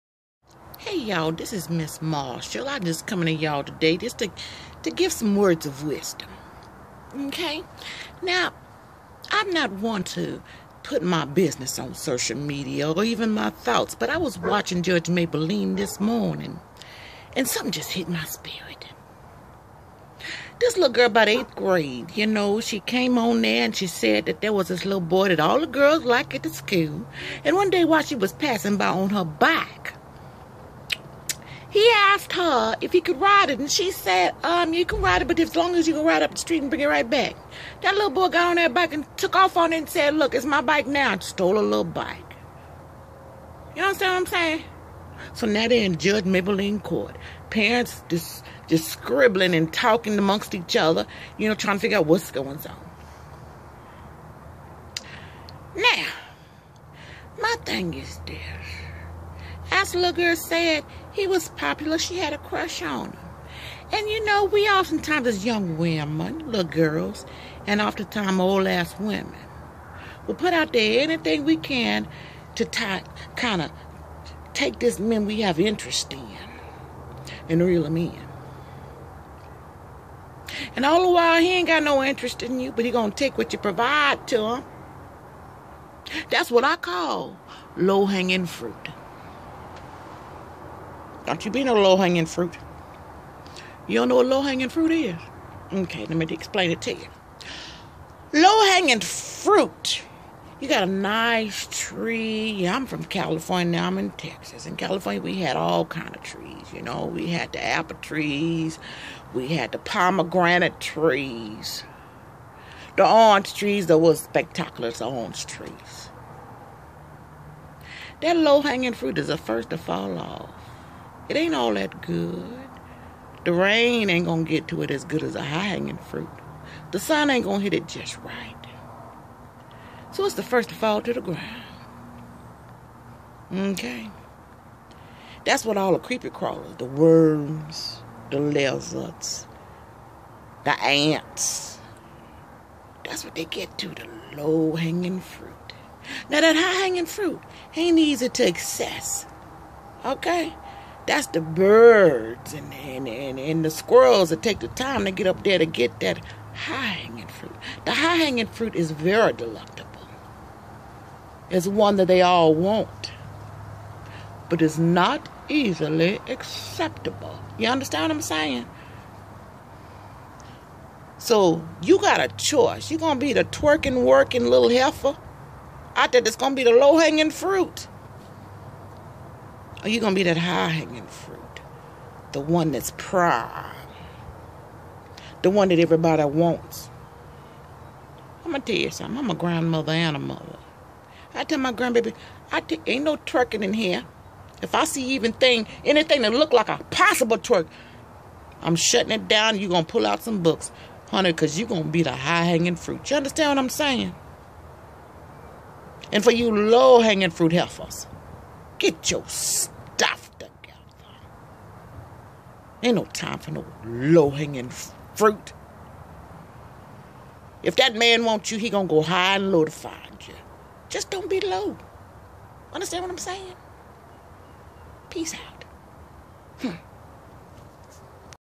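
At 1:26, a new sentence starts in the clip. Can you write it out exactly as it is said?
That's what I call low-hanging fruit.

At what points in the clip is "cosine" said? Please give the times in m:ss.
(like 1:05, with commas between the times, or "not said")
not said.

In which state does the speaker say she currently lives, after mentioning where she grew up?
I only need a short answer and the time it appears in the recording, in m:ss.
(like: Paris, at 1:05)
Texas, at 1:44.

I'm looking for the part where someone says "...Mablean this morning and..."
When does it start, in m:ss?
0:15.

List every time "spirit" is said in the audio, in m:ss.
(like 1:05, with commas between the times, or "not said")
0:18.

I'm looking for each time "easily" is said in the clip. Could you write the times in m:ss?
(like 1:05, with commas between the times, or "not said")
2:45.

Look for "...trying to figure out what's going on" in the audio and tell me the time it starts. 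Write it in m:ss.
0:51.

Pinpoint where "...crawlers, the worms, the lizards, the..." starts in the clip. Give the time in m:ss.
2:16.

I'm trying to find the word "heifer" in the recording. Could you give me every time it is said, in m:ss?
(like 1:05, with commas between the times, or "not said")
2:54, 3:27.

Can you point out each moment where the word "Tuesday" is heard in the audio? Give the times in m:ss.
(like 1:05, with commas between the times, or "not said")
not said.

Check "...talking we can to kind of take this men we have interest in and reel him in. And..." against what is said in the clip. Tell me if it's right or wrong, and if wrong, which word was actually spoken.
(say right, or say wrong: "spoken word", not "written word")
wrong: "anything", not "talking".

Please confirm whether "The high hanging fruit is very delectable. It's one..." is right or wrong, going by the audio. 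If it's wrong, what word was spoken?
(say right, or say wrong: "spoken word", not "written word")
right.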